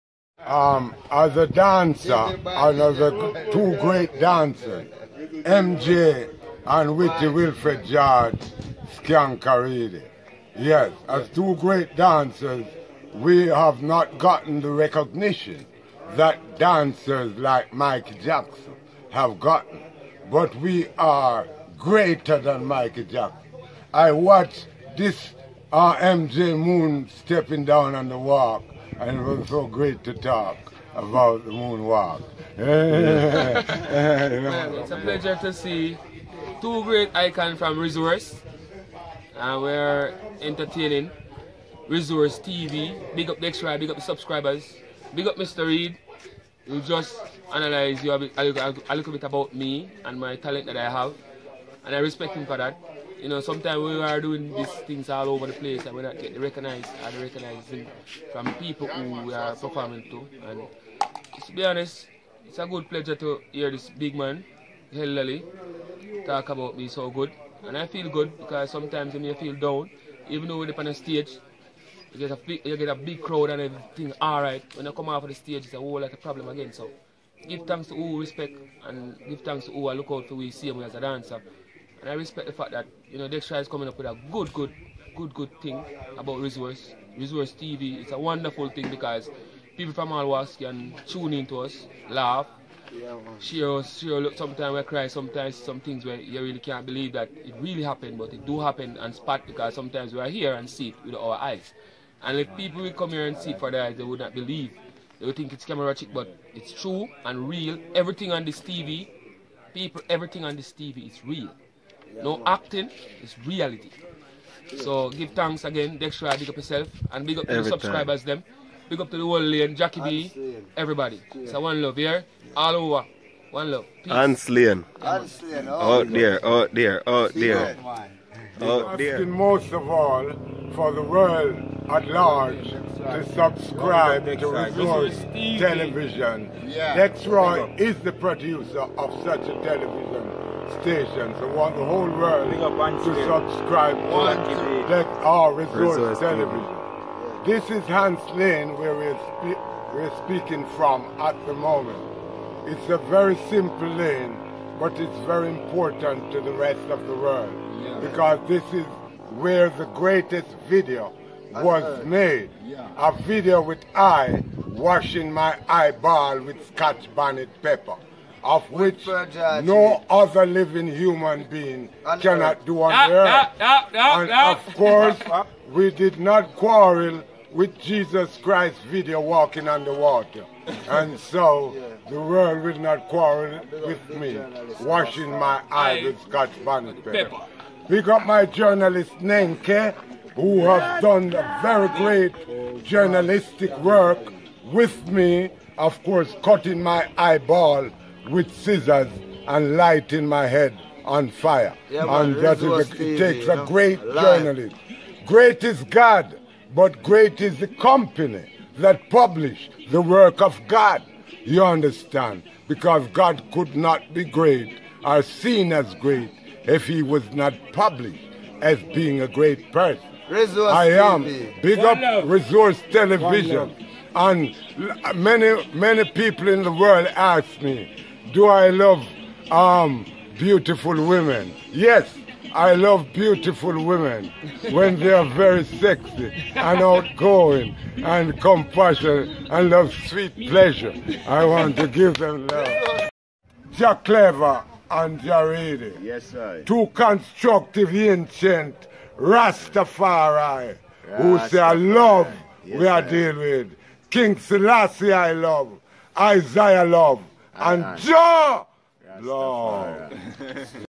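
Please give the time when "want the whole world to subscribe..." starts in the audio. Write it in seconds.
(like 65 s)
141 s.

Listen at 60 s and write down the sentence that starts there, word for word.
And to be honest, it's a good pleasure to hear this big man, Hillary, talk about me so good.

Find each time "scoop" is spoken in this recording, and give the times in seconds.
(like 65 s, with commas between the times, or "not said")
not said.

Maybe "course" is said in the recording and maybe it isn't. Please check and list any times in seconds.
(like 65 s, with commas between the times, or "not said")
174 s, 196 s.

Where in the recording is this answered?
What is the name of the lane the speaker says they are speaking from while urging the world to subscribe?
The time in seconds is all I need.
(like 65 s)
147 s.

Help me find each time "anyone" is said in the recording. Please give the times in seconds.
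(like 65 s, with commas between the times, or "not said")
not said.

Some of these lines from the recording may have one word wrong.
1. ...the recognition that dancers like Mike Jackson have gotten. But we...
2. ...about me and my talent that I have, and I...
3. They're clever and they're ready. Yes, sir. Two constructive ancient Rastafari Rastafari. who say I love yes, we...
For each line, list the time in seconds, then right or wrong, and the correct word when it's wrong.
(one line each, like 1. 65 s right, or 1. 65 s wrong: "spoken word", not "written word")
1. 14 s right
2. 49 s right
3. 243 s right.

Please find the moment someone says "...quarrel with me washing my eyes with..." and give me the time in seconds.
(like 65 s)
183 s.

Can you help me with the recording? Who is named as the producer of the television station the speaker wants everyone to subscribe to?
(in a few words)
Dexroy.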